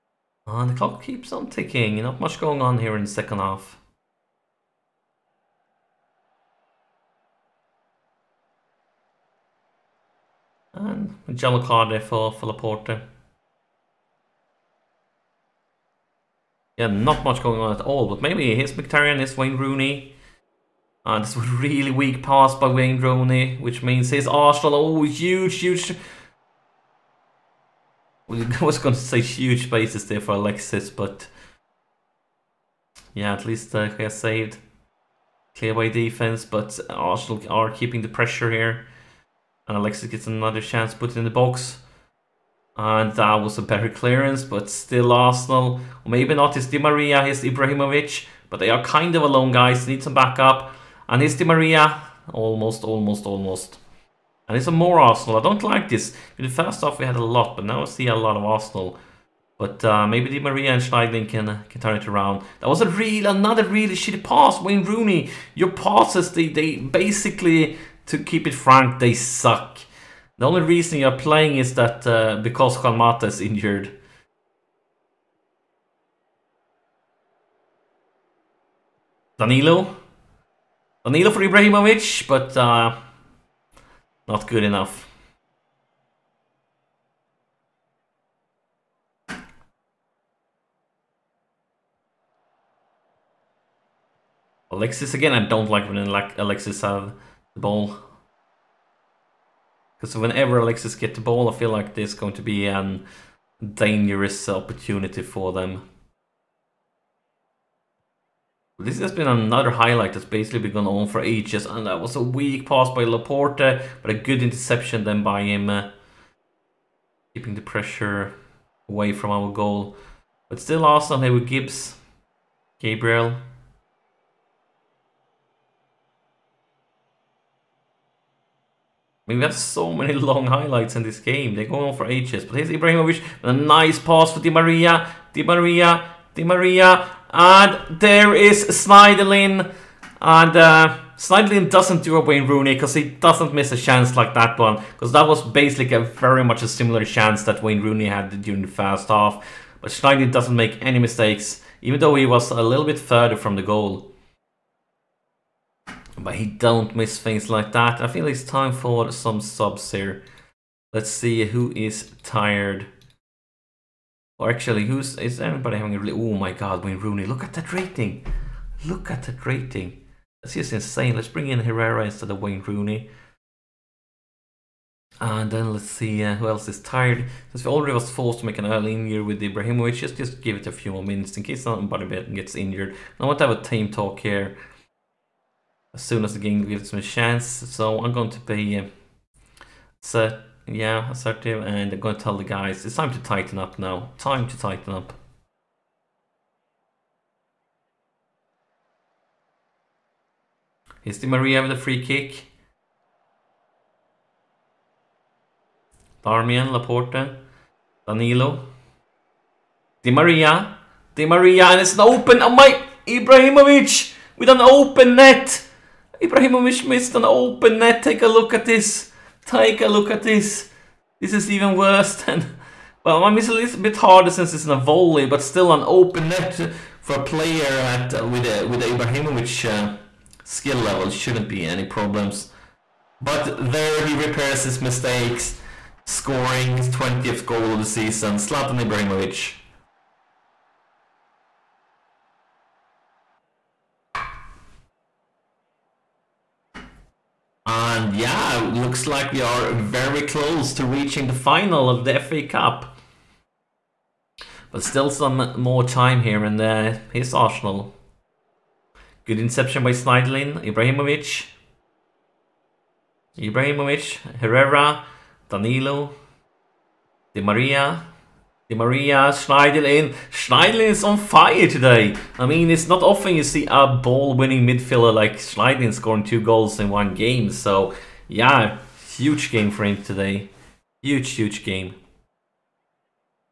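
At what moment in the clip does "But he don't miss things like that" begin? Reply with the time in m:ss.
2:36.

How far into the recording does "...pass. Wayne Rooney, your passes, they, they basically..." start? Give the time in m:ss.
1:04.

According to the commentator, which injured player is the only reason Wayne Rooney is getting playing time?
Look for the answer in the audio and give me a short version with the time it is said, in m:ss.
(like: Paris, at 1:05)
Kalmata, at 1:12.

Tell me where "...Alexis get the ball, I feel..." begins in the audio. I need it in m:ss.
1:40.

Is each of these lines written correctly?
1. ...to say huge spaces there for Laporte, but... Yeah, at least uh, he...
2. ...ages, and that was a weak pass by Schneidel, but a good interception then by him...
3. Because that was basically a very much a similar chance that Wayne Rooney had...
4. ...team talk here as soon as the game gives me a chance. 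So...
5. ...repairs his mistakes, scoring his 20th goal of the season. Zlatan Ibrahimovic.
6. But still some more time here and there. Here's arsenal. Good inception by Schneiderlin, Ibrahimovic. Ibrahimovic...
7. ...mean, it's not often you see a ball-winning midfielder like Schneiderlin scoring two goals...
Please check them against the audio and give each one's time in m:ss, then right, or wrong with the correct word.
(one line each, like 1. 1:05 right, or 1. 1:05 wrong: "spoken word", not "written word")
1. 0:28 wrong: "Alexis", not "Laporte"
2. 1:51 wrong: "Laporte", not "Schneidel"
3. 2:24 right
4. 3:03 right
5. 3:54 right
6. 4:14 right
7. 4:32 right.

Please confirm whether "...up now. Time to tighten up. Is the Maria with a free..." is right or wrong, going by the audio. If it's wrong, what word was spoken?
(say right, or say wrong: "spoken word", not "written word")
right.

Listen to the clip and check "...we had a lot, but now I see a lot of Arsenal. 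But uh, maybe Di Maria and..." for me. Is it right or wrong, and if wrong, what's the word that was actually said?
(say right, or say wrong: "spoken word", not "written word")
right.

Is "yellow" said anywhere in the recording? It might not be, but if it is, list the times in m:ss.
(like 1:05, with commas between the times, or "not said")
0:11.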